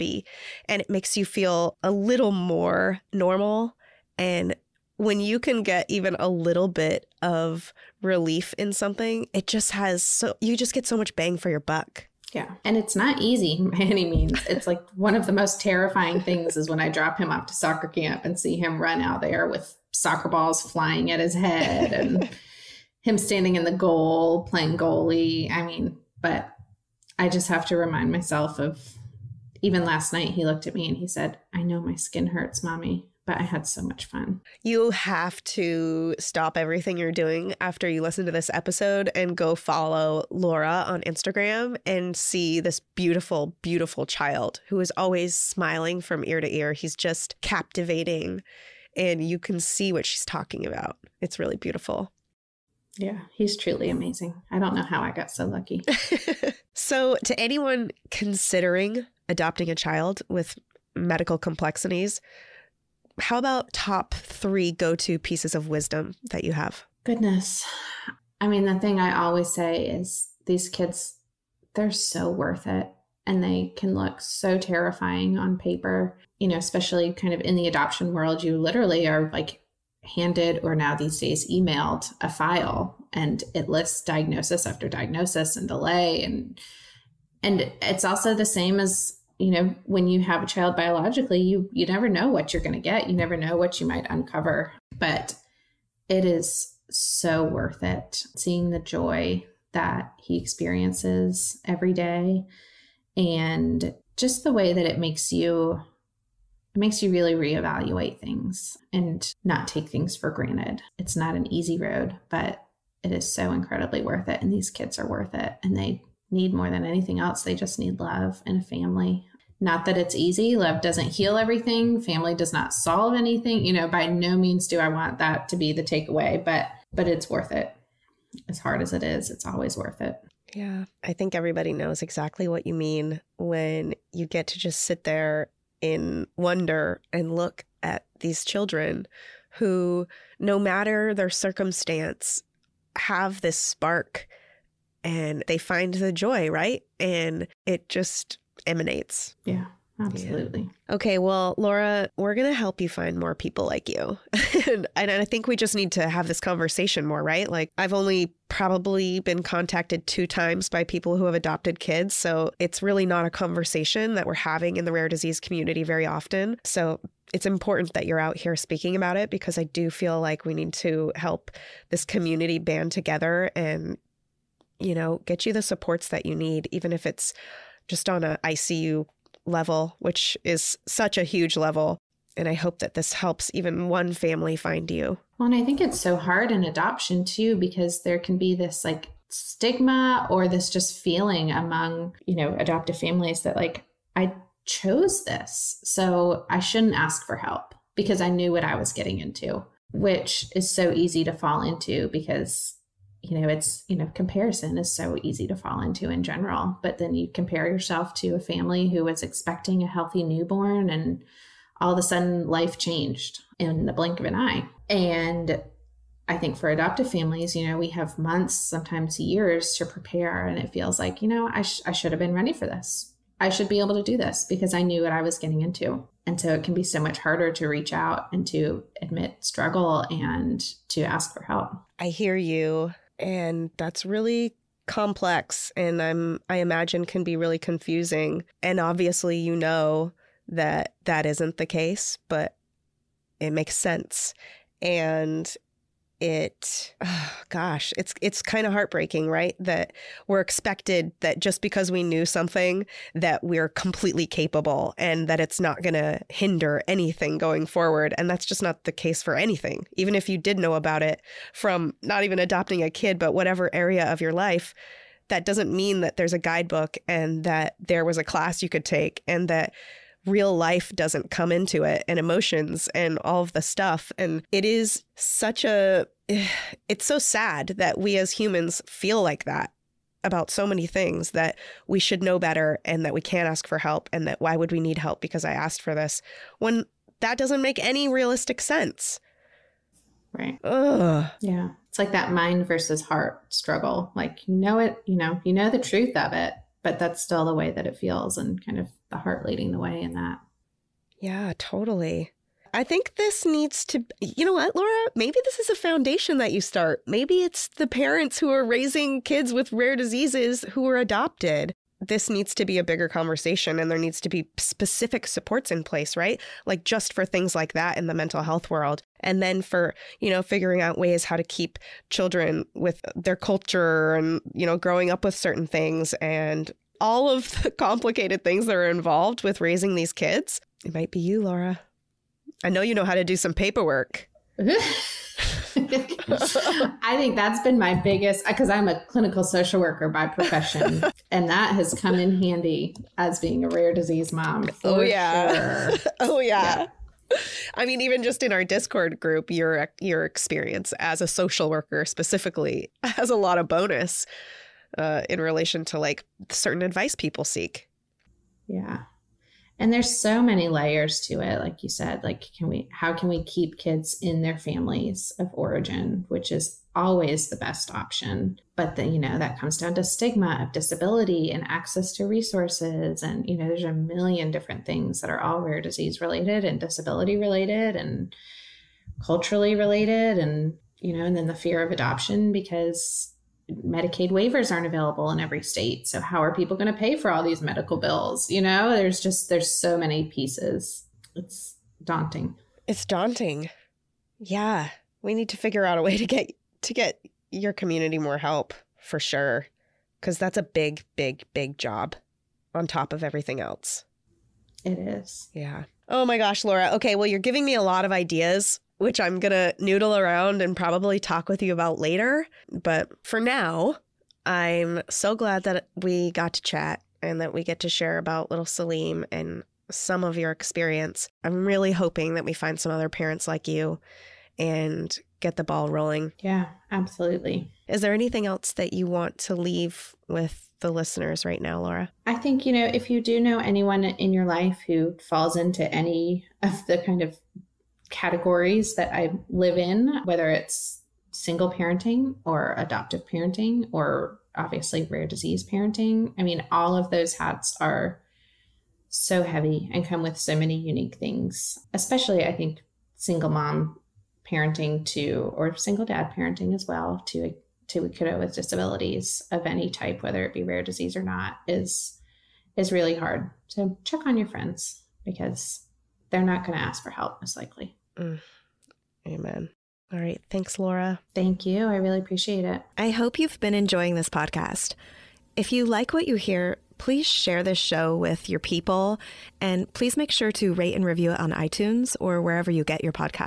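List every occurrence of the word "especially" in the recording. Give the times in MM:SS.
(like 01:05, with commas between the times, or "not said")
01:16, 07:31.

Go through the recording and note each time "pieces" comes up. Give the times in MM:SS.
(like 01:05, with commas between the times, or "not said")
01:05, 06:30.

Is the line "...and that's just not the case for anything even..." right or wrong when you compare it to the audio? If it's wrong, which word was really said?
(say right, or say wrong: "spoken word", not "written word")
right.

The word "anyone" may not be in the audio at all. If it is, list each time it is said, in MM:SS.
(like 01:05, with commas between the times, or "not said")
00:57, 07:13.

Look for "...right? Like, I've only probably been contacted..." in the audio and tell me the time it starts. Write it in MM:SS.
02:37.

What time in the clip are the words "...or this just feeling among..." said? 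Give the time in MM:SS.
03:10.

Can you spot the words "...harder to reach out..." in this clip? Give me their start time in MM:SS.
03:47.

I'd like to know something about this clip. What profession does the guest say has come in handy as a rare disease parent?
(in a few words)
Clinical social worker.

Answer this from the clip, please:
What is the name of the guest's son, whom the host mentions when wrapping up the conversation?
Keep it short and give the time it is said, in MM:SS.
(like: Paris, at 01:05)
Salim, at 06:58.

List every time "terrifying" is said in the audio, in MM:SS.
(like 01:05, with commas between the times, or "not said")
00:15, 01:14.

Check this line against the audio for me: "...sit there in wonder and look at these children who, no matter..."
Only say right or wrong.
right.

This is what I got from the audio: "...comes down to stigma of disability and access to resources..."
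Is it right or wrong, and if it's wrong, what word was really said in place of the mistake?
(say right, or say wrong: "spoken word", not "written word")
right.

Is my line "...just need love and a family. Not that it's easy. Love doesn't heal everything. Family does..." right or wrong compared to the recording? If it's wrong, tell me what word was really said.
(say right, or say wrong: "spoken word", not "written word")
right.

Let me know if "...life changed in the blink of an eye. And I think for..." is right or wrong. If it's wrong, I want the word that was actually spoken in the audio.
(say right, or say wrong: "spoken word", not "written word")
right.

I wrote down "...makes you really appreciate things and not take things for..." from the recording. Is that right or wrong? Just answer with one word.
wrong.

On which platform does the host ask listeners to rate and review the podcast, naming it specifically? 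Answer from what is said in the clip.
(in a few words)
iTunes.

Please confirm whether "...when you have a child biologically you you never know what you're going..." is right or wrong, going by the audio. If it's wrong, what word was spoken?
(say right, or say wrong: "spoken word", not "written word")
right.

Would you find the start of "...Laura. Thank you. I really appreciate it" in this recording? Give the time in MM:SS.
07:50.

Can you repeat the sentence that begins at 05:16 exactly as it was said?
Like just for things like that in the mental health world.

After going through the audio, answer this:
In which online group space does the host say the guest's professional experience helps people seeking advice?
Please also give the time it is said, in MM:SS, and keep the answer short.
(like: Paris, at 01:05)
Discord, at 05:48.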